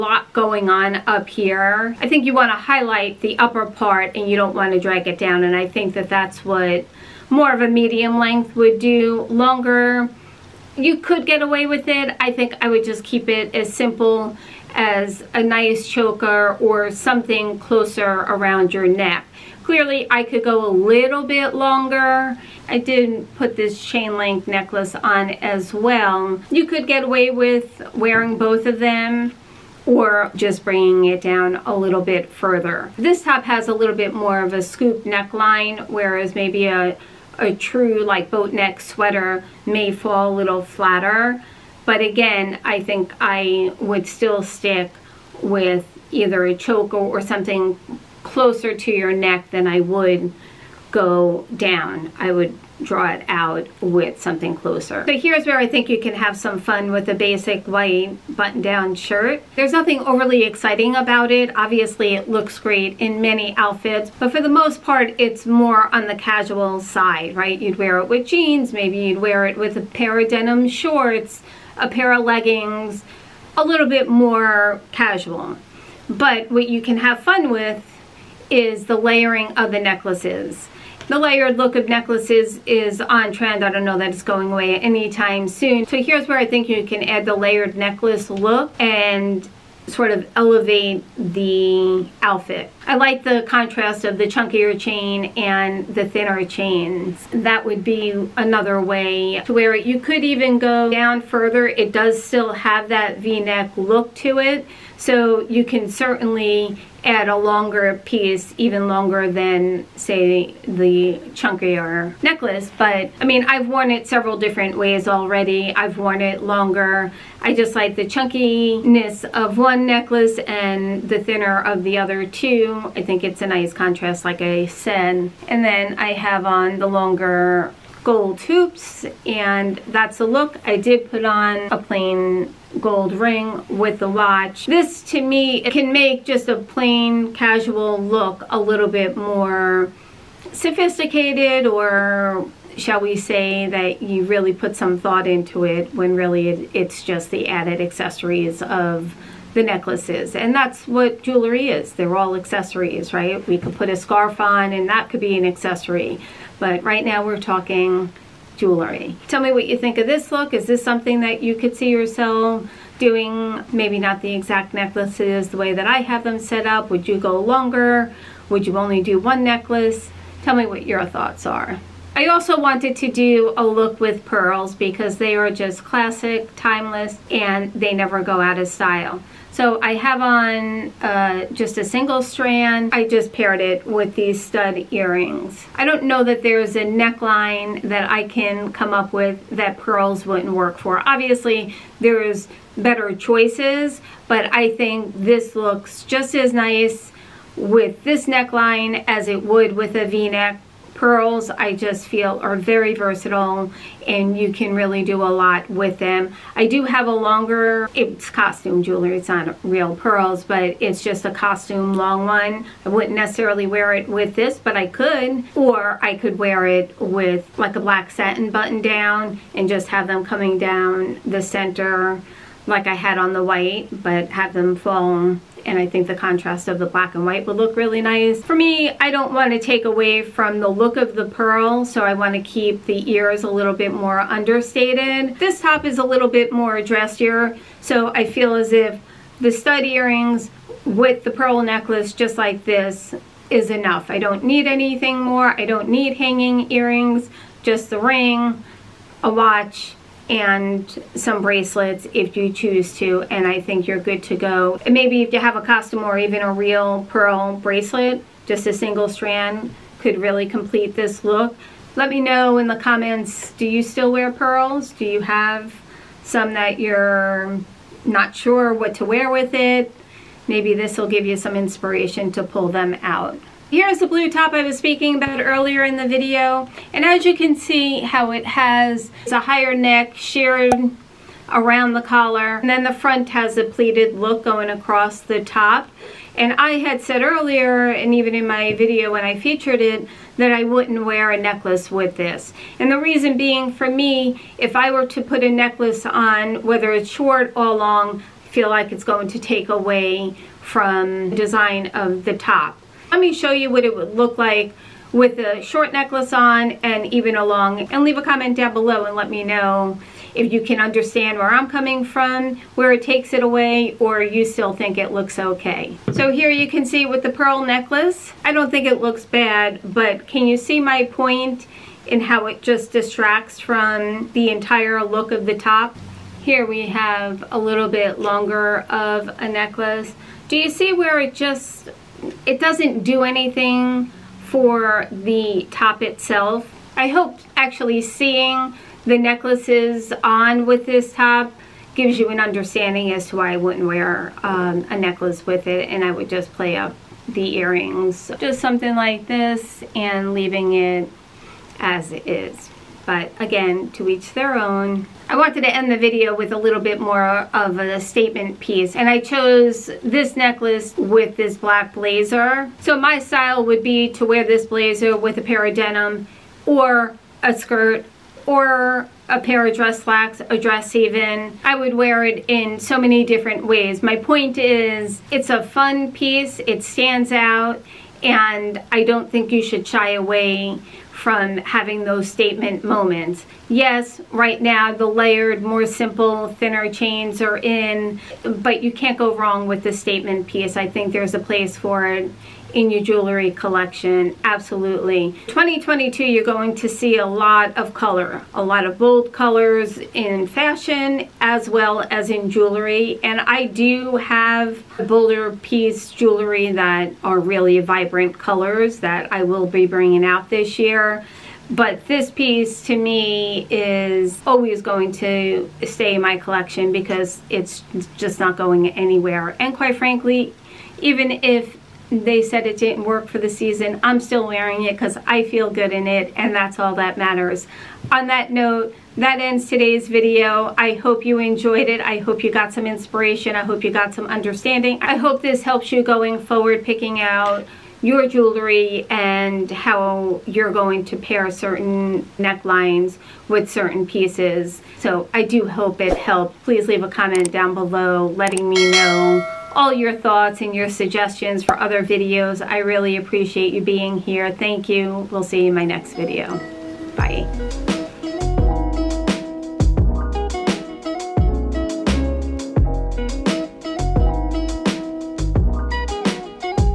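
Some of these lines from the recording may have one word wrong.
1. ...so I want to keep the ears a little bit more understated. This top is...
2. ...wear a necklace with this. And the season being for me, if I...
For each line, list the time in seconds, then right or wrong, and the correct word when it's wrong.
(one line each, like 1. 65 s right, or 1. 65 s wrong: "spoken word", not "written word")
1. 231 s right
2. 291 s wrong: "reason", not "season".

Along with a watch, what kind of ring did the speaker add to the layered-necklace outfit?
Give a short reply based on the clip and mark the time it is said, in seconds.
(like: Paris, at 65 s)
plain gold ring, at 131 s.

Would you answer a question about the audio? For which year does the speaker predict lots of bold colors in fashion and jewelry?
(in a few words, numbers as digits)
2022.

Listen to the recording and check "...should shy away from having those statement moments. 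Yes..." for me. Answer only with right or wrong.
right.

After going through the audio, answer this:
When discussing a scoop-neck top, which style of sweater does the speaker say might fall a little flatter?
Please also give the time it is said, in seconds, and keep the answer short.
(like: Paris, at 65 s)
boat neck sweater, at 38 s.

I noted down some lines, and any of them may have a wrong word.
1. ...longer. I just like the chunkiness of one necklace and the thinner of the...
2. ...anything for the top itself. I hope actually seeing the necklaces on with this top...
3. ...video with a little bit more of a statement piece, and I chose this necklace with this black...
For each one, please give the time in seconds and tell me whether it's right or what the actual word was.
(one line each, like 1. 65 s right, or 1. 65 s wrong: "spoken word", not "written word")
1. 116 s right
2. 333 s right
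3. 355 s right.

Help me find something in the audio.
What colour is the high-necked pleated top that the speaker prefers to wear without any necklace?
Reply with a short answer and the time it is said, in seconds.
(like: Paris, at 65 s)
blue, at 274 s.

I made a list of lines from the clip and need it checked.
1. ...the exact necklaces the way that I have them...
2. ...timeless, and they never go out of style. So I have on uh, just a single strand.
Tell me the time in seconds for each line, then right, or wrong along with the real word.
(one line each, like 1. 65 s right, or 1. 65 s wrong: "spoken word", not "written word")
1. 164 s right
2. 176 s right.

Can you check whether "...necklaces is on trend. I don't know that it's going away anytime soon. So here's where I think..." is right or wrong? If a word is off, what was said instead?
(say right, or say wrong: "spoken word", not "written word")
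right.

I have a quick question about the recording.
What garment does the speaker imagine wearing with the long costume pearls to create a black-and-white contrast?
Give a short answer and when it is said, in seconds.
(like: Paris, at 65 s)
black satin button down, at 217 s.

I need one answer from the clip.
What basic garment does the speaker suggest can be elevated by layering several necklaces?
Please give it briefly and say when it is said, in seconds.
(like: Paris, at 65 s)
white button-down shirt, at 57 s.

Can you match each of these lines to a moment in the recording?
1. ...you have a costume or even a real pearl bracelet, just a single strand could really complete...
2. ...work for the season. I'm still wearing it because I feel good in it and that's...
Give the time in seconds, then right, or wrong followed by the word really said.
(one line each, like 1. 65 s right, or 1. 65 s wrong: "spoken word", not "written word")
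1. 255 s right
2. 423 s right.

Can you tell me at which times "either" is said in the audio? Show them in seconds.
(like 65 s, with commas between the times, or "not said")
46 s.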